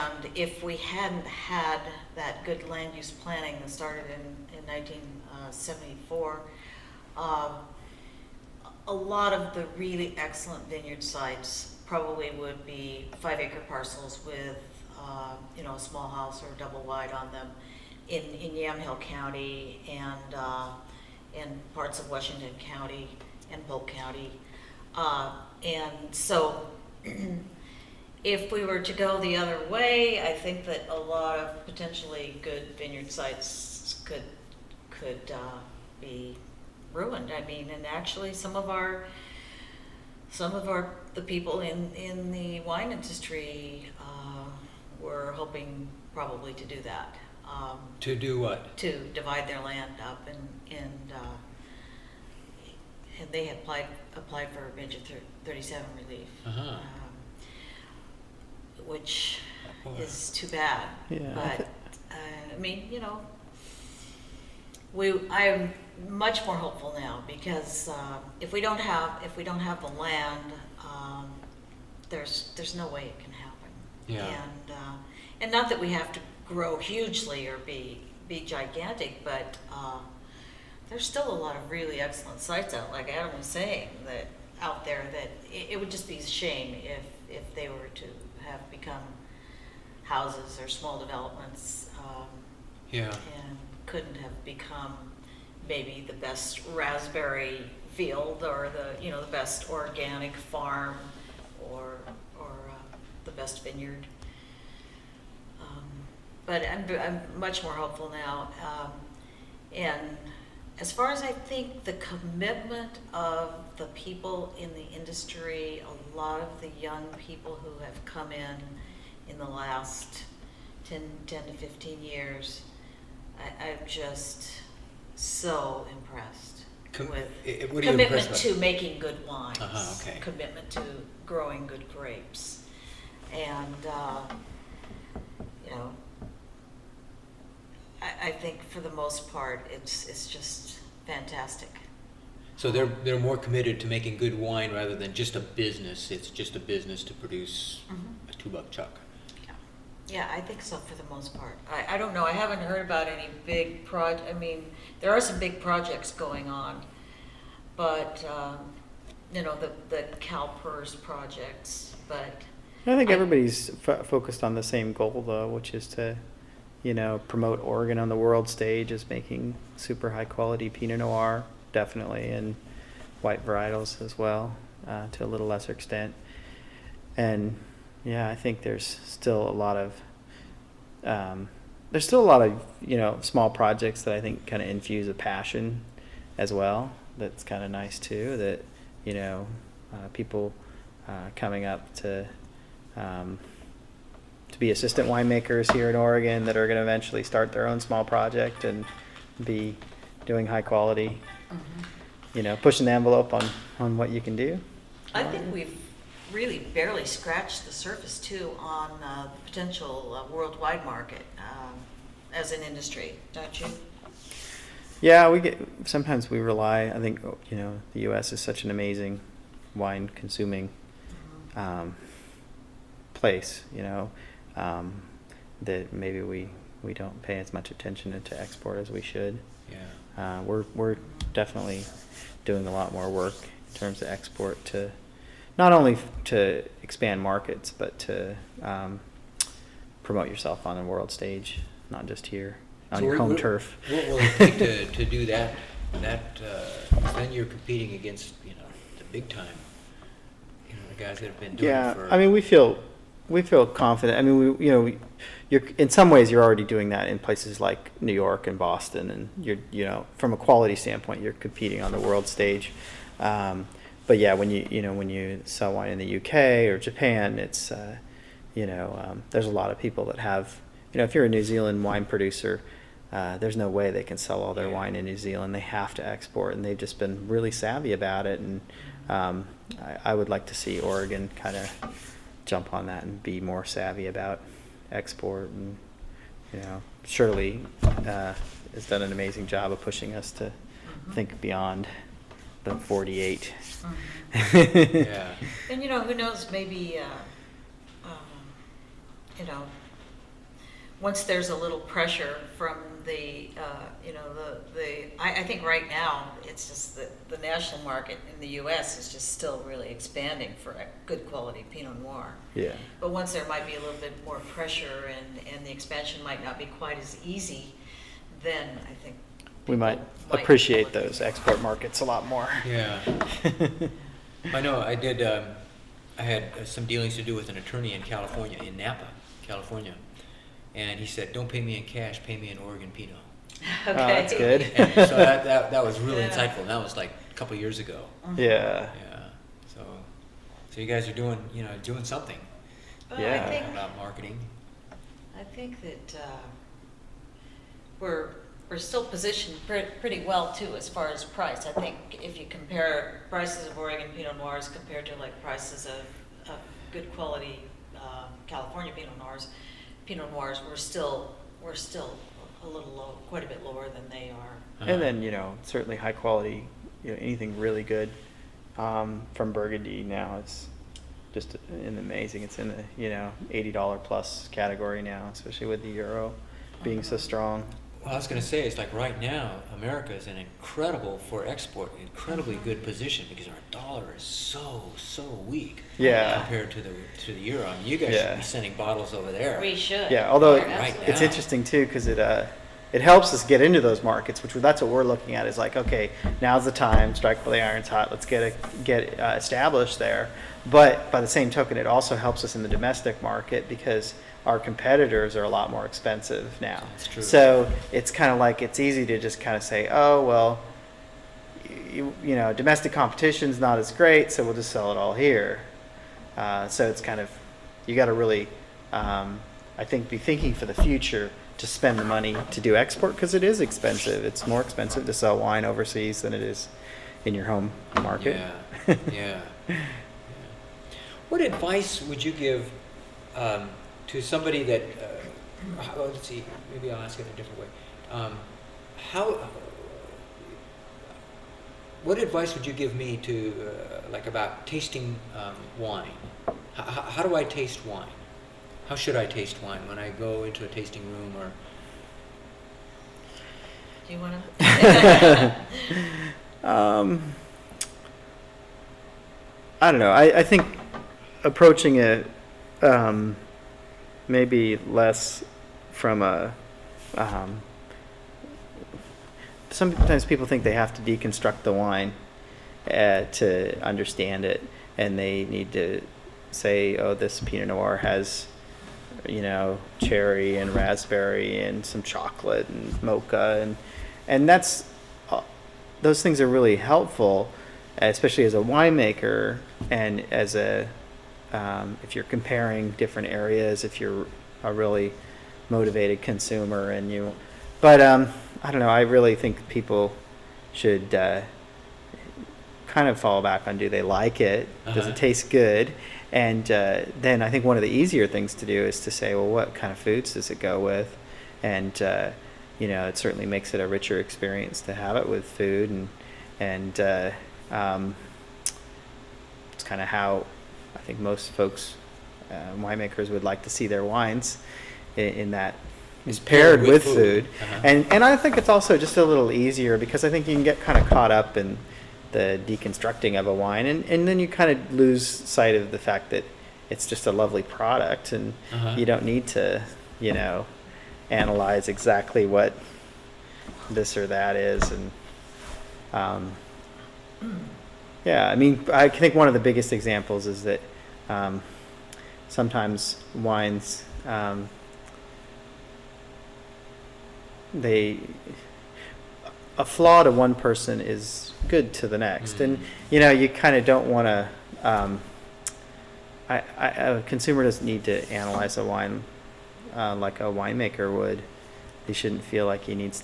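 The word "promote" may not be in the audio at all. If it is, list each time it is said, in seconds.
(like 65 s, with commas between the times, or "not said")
167 s, 240 s.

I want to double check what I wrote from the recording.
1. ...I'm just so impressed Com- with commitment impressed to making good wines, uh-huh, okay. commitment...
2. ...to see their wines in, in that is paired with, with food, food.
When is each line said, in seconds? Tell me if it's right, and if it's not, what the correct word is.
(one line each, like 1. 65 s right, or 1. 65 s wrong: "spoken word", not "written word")
1. 123 s right
2. 523 s right.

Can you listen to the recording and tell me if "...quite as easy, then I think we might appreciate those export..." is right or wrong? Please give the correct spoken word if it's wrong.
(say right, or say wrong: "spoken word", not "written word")
right.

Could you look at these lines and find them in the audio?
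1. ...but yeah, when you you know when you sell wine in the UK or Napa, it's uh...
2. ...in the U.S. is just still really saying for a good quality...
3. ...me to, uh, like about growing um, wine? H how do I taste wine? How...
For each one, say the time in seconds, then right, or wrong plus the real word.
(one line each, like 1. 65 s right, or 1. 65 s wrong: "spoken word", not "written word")
1. 264 s wrong: "Japan", not "Napa"
2. 308 s wrong: "expanding", not "saying"
3. 442 s wrong: "tasting", not "growing".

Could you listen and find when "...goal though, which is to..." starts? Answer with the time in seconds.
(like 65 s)
164 s.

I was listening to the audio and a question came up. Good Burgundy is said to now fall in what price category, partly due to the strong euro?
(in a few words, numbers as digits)
$80 plus.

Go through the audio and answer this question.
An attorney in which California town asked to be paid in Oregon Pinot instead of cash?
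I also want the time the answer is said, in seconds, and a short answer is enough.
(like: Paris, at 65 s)
Napa, at 328 s.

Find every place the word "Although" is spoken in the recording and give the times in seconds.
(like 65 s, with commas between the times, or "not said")
390 s.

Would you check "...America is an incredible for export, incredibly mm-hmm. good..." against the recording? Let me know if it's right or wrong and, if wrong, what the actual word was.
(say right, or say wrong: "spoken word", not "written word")
right.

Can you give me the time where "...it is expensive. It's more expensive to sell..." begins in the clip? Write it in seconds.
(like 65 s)
423 s.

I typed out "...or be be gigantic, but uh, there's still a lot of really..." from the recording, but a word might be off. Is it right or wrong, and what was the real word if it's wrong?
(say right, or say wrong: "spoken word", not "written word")
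right.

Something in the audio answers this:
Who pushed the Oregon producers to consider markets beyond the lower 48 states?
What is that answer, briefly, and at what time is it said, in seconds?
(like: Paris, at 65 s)
Shirley, at 287 s.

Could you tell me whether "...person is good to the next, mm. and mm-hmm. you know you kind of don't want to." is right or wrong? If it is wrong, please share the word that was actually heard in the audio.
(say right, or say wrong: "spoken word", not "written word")
right.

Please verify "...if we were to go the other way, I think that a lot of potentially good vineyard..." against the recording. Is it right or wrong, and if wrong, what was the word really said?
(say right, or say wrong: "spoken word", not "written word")
right.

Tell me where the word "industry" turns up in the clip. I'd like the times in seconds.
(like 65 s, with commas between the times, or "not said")
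42 s, 114 s, 212 s.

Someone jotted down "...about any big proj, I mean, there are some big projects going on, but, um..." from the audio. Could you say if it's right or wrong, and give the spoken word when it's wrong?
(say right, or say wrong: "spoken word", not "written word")
right.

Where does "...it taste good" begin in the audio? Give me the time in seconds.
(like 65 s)
505 s.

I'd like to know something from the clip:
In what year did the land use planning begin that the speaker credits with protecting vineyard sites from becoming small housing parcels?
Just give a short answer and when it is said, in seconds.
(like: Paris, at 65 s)
1974, at 4 s.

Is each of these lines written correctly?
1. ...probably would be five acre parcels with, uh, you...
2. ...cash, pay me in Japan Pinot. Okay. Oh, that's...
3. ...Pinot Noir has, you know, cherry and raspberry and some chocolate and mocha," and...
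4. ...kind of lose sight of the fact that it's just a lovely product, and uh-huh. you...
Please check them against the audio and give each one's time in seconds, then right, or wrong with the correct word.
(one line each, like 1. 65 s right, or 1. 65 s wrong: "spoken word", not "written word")
1. 11 s right
2. 331 s wrong: "Oregon", not "Japan"
3. 477 s right
4. 534 s right.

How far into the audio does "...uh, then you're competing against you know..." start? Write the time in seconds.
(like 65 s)
246 s.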